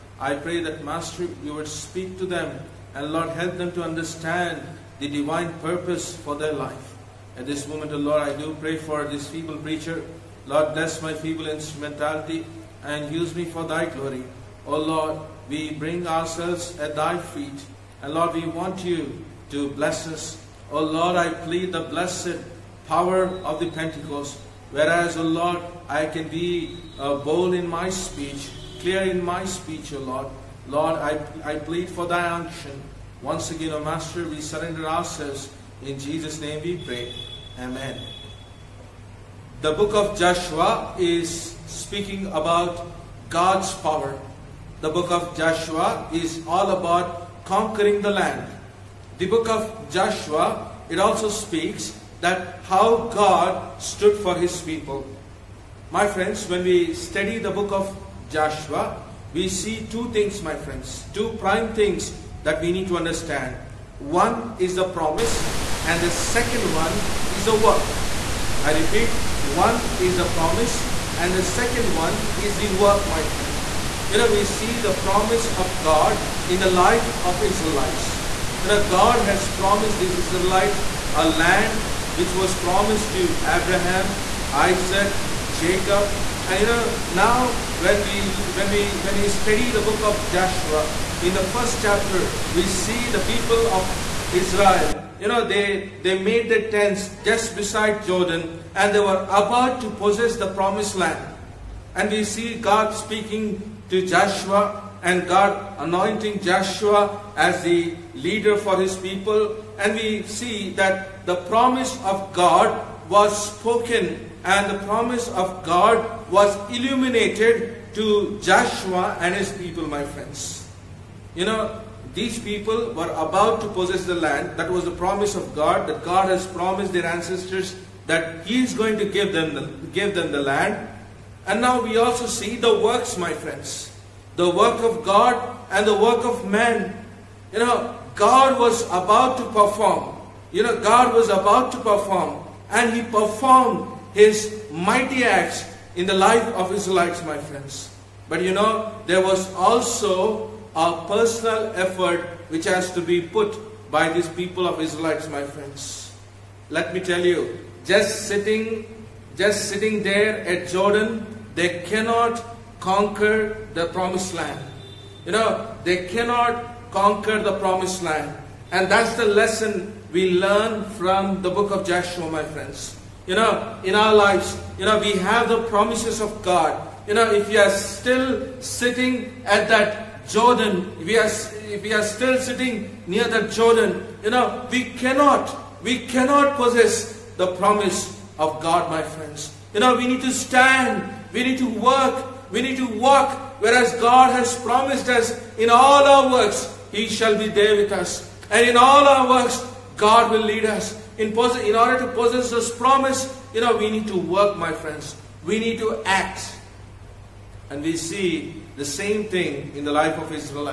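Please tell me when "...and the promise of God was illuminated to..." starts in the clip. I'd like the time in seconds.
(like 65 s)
114 s.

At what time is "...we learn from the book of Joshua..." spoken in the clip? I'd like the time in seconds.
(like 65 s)
170 s.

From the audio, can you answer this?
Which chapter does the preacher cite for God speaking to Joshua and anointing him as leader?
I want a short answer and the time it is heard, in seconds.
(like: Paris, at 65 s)
First chapter, at 91 s.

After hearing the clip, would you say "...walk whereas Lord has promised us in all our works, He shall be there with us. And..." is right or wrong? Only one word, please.
wrong.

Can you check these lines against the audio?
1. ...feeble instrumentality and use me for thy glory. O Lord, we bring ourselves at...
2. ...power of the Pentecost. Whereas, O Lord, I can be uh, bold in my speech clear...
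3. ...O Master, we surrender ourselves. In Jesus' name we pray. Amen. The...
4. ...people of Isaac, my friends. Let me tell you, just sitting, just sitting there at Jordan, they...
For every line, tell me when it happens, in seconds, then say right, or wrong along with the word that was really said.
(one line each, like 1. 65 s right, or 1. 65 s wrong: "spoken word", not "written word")
1. 11 s right
2. 22 s right
3. 33 s right
4. 154 s wrong: "Israelites", not "Isaac".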